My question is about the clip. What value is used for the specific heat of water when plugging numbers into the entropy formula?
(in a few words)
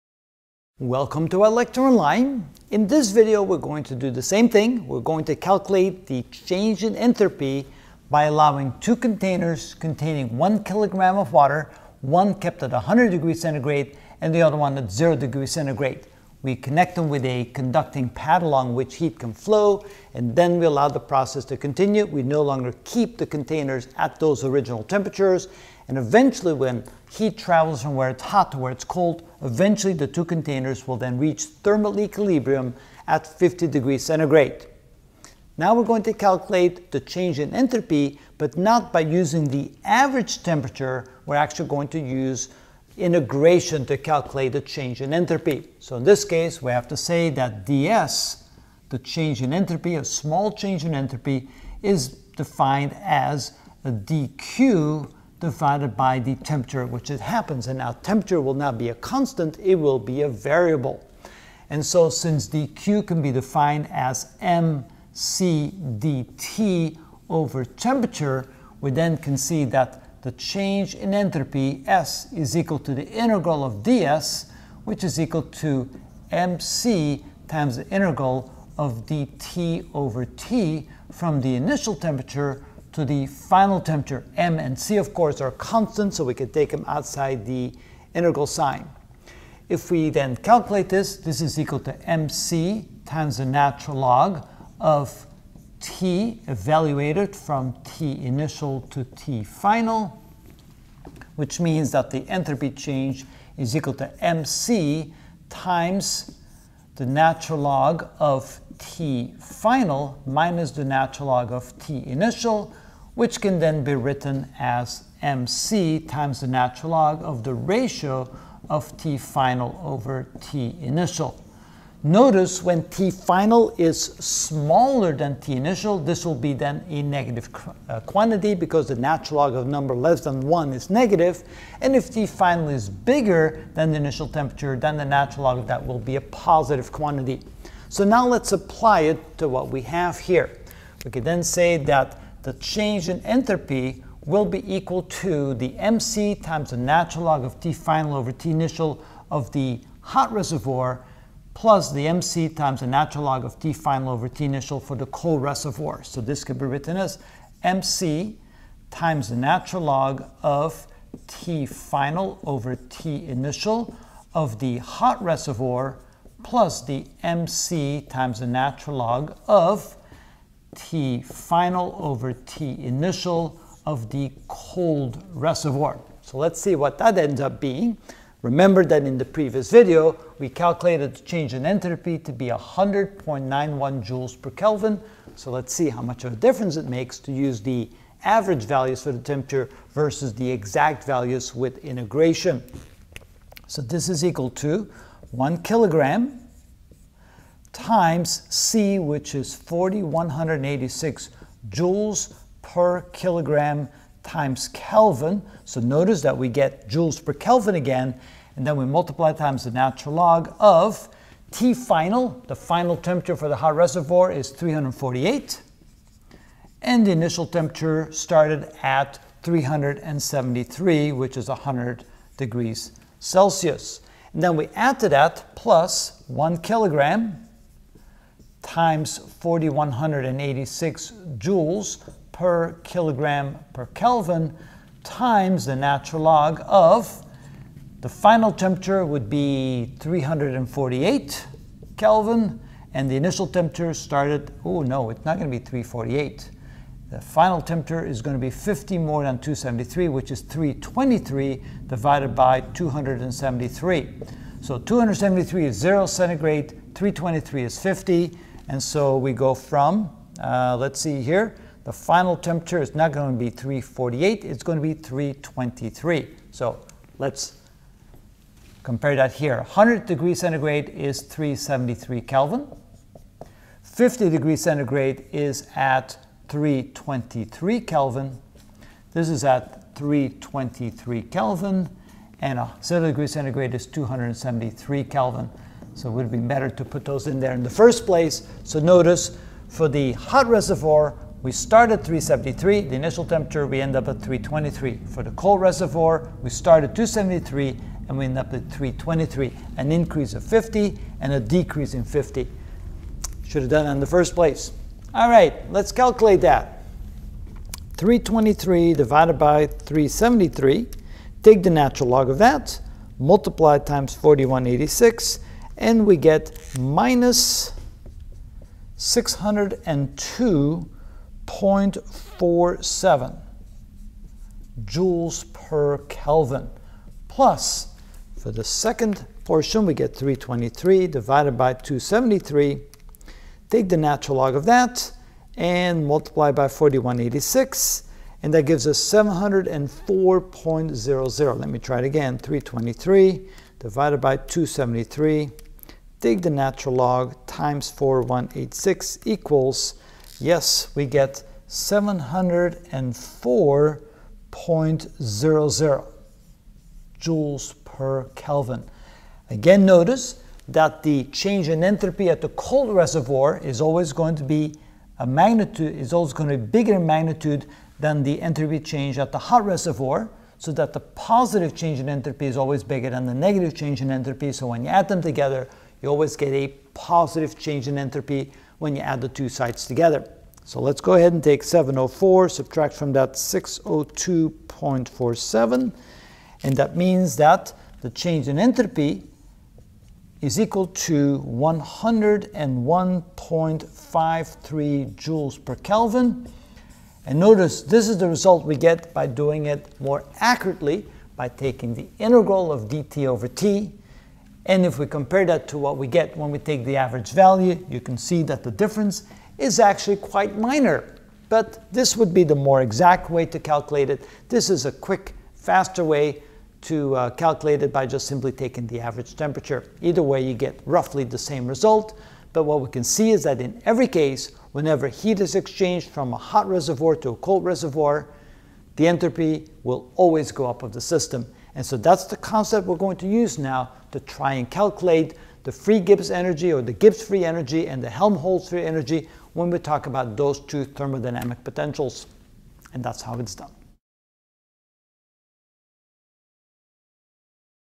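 4186 joules per kilogram Kelvin.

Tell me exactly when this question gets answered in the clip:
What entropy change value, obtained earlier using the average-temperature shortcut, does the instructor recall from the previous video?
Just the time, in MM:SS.
03:02.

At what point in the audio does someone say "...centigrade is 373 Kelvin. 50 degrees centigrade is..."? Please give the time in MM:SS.
04:30.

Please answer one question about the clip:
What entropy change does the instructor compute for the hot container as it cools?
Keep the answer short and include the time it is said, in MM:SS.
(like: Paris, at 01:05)
-602.47 joules per Kelvin, at 05:16.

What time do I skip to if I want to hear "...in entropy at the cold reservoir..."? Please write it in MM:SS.
06:01.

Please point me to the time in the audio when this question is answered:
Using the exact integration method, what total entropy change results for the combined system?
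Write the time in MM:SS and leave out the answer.
06:31.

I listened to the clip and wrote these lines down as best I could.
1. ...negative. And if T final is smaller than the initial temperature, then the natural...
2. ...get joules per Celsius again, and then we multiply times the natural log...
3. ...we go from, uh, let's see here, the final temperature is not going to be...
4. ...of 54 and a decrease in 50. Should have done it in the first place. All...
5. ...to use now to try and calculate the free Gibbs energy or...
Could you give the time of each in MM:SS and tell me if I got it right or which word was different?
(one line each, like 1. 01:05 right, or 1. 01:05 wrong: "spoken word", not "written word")
1. 02:10 wrong: "bigger", not "smaller"
2. 03:26 wrong: "Kelvin", not "Celsius"
3. 04:19 right
4. 05:00 wrong: "50", not "54"
5. 07:13 right.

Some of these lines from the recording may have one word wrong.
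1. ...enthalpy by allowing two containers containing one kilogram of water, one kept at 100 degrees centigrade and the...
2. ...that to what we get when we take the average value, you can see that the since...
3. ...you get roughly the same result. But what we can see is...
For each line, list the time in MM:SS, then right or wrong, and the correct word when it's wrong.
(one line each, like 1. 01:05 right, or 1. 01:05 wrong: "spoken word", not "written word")
1. 00:06 right
2. 06:45 wrong: "difference", not "since"
3. 07:00 right.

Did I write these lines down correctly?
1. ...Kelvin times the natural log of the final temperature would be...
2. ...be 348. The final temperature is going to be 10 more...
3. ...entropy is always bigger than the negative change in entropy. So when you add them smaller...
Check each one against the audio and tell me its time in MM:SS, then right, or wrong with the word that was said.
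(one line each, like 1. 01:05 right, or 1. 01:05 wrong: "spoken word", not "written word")
1. 03:53 right
2. 04:05 wrong: "50", not "10"
3. 06:12 wrong: "together", not "smaller".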